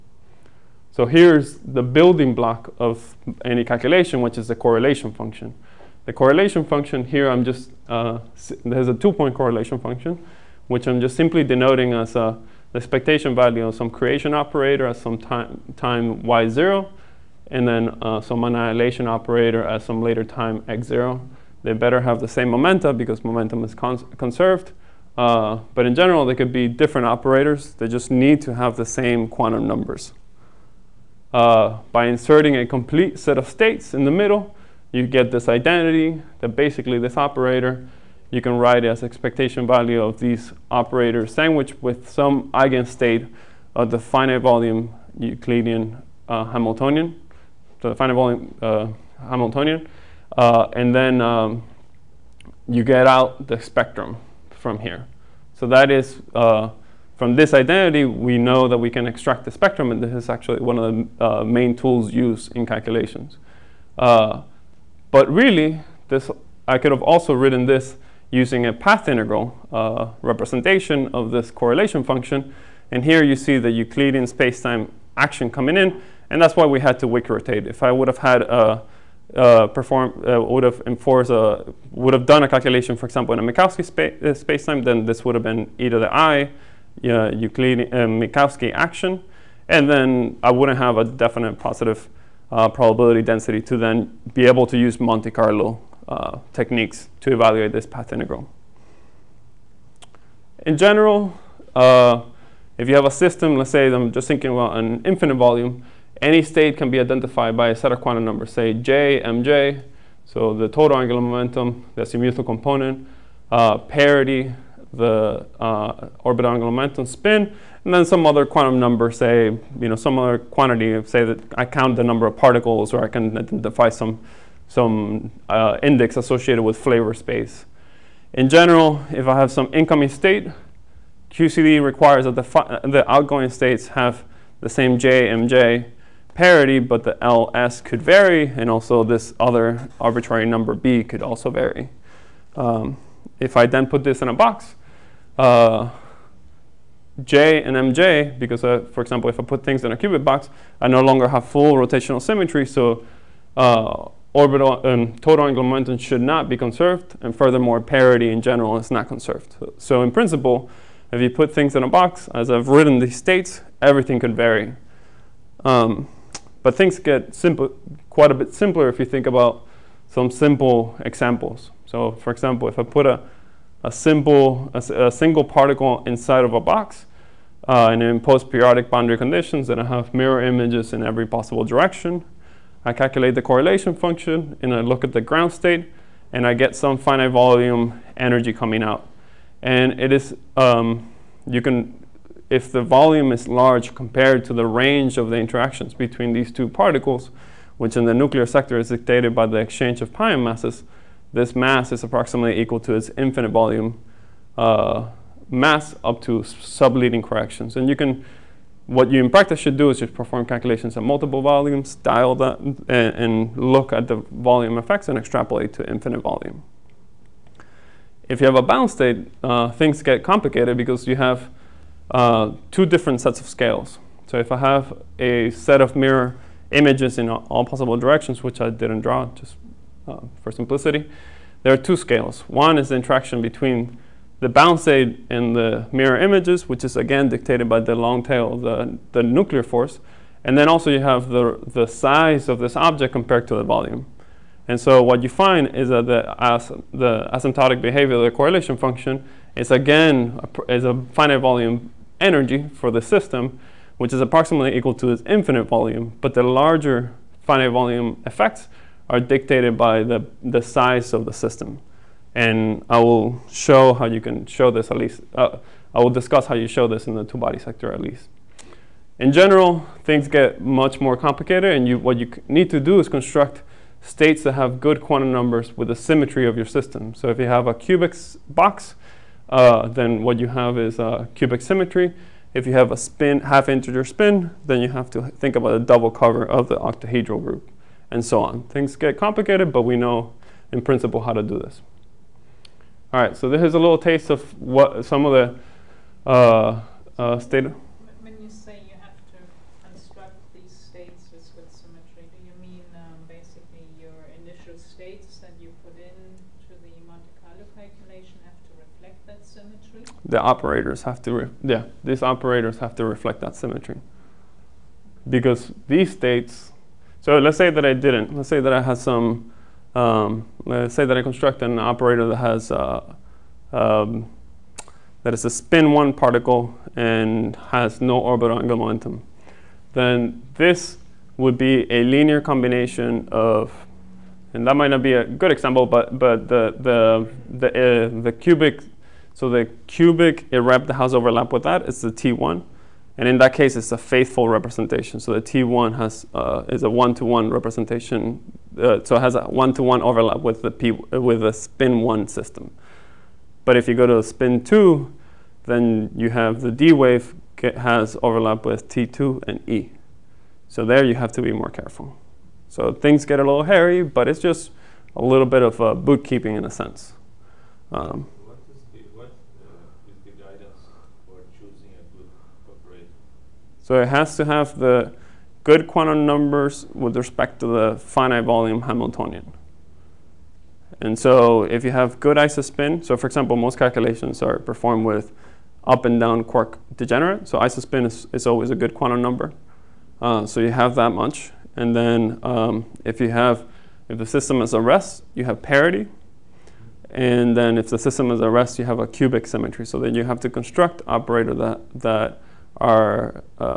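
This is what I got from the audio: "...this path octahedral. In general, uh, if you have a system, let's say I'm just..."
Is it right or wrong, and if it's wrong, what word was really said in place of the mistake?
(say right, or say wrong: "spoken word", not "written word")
wrong: "integral", not "octahedral".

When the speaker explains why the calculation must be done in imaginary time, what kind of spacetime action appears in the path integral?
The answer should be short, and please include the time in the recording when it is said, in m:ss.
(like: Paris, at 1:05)
Euclidean spacetime action, at 1:13.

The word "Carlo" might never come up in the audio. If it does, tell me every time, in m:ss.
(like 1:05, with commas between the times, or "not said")
1:35, 5:07.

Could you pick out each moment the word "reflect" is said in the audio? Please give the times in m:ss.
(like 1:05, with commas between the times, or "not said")
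5:08, 5:13.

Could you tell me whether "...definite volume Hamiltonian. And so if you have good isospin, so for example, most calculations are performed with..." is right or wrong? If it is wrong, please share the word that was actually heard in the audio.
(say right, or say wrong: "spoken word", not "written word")
wrong: "finite", not "definite".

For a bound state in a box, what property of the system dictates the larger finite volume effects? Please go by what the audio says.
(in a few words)
the size of the system.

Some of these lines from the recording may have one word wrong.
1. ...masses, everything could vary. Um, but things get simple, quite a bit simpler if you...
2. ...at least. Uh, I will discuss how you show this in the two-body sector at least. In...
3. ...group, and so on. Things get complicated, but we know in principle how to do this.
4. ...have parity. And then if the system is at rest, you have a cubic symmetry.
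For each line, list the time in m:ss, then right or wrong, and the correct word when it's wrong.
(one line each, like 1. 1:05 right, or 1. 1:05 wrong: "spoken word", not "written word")
1. 2:43 wrong: "states", not "masses"
2. 4:24 right
3. 4:47 right
4. 6:35 right.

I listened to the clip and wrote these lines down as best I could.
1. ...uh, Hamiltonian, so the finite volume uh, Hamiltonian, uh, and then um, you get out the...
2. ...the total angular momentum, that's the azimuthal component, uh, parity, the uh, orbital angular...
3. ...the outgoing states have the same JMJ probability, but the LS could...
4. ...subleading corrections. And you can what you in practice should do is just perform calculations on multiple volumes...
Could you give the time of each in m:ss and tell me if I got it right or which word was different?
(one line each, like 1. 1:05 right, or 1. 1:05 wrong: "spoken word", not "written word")
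1. 0:46 right
2. 1:50 right
3. 2:12 wrong: "parity", not "probability"
4. 3:26 right.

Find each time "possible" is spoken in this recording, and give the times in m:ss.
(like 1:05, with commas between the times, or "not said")
3:01, 3:47.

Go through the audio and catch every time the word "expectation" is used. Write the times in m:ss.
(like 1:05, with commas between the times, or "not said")
0:12, 0:39.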